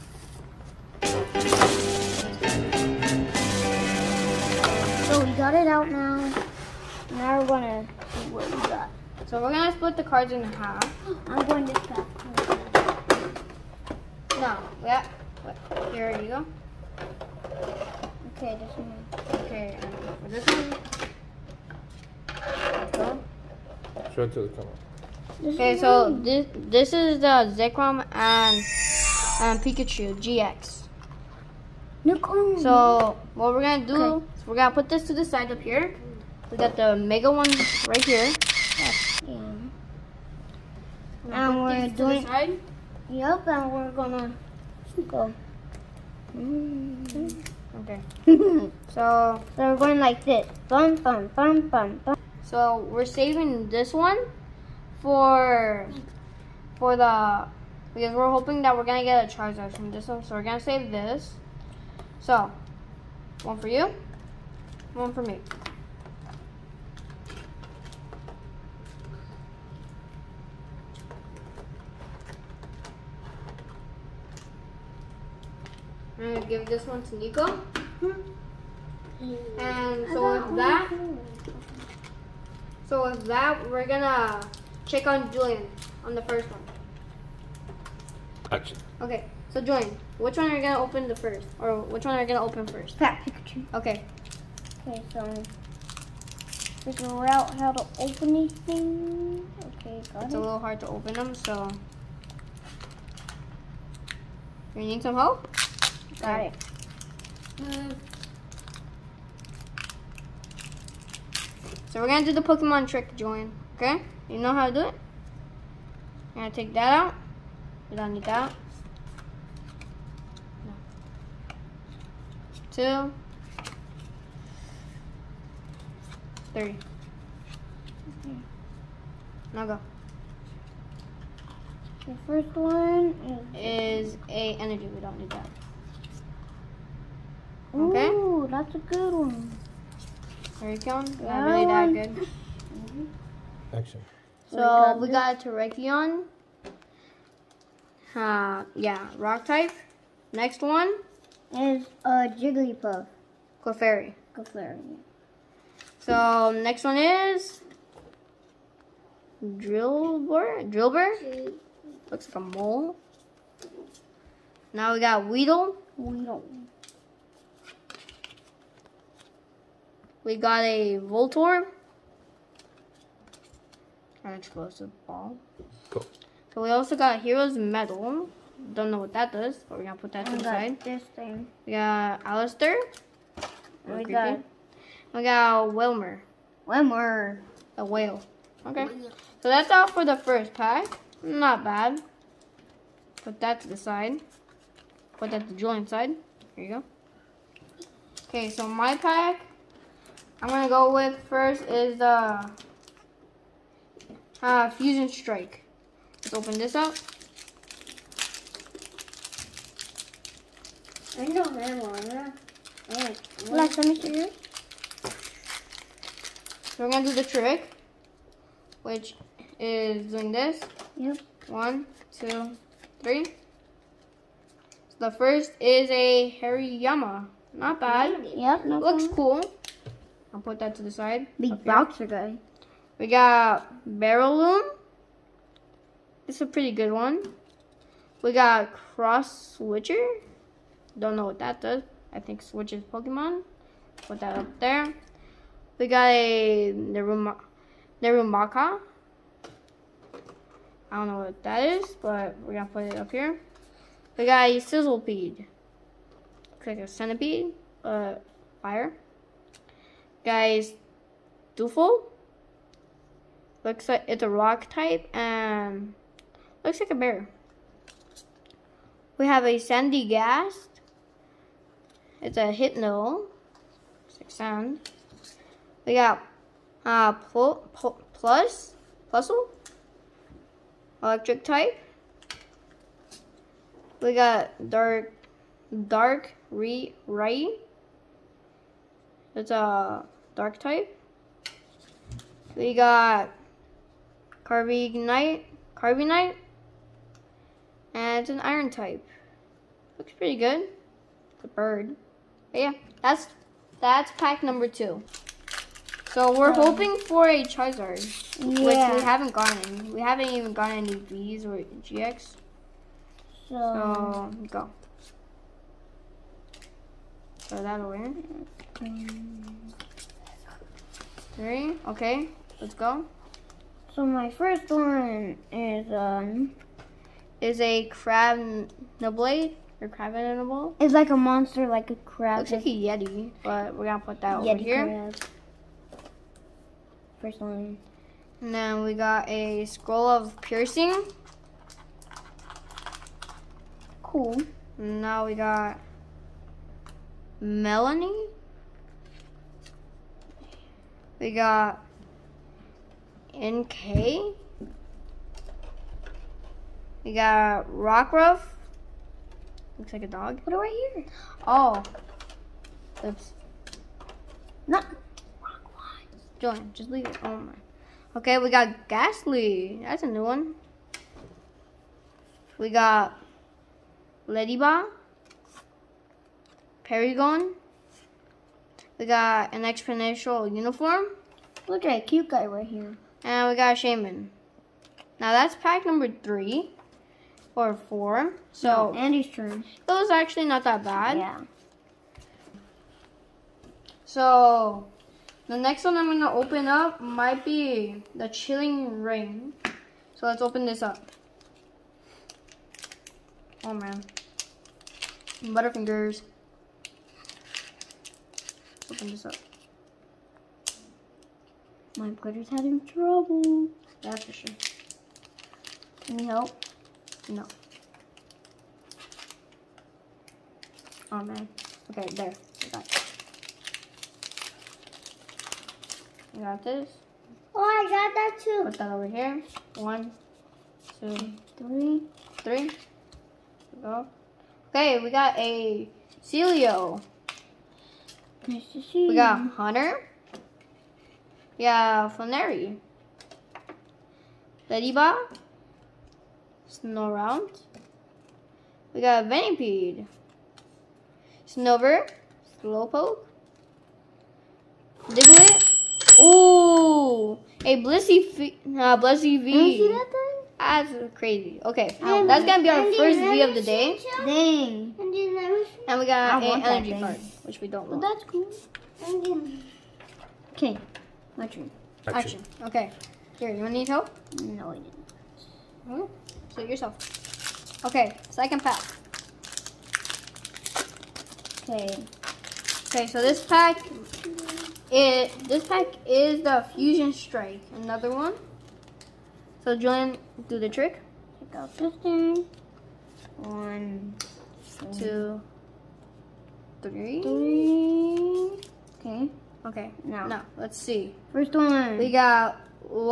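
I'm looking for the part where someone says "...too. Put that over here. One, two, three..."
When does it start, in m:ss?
7:08.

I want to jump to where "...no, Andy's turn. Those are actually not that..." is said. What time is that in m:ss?
6:28.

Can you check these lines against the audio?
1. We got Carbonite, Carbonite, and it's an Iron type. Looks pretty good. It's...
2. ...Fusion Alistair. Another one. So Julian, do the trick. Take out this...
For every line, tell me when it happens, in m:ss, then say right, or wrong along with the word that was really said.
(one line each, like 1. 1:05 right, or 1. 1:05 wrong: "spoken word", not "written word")
1. 4:52 right
2. 8:06 wrong: "Strike", not "Alistair".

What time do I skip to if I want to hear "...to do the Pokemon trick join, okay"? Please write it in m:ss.
1:52.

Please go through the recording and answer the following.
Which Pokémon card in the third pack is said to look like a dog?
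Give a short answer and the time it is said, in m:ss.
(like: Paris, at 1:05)
Rockruff, at 5:57.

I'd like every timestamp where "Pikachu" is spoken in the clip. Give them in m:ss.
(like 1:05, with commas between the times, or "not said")
0:29, 1:33.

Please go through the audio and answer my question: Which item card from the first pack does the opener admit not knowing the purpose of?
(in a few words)
Hero's Medal.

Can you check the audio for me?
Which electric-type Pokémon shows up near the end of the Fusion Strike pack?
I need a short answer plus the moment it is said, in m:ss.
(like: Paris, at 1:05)
Plusle, at 4:39.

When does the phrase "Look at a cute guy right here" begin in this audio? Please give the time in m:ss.
6:21.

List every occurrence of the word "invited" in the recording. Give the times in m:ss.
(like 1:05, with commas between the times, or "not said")
not said.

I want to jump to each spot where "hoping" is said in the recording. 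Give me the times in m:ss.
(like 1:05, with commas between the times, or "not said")
0:58, 5:06.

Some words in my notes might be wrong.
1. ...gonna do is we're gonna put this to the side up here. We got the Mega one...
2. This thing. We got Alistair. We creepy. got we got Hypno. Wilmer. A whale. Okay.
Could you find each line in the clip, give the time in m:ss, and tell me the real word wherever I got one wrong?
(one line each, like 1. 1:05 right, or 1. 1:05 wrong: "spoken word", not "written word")
1. 0:33 right
2. 3:00 wrong: "Wilmer", not "Hypno".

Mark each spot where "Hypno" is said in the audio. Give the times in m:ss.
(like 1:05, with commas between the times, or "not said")
4:32.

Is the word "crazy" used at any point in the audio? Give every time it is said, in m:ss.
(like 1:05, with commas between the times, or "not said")
7:41.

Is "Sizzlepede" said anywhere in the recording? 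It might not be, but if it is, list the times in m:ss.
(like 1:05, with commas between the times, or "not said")
4:14.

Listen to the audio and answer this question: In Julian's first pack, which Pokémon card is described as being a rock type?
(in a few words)
Terrakion.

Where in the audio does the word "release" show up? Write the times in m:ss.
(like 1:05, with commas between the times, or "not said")
not said.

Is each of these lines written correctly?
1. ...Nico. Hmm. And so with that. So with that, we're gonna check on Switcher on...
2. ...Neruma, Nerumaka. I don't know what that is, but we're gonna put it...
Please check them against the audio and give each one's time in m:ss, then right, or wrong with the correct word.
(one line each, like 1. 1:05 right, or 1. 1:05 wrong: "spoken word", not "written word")
1. 1:17 wrong: "Julian", not "Switcher"
2. 4:06 right.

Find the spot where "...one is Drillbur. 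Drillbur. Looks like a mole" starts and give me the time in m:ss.
2:36.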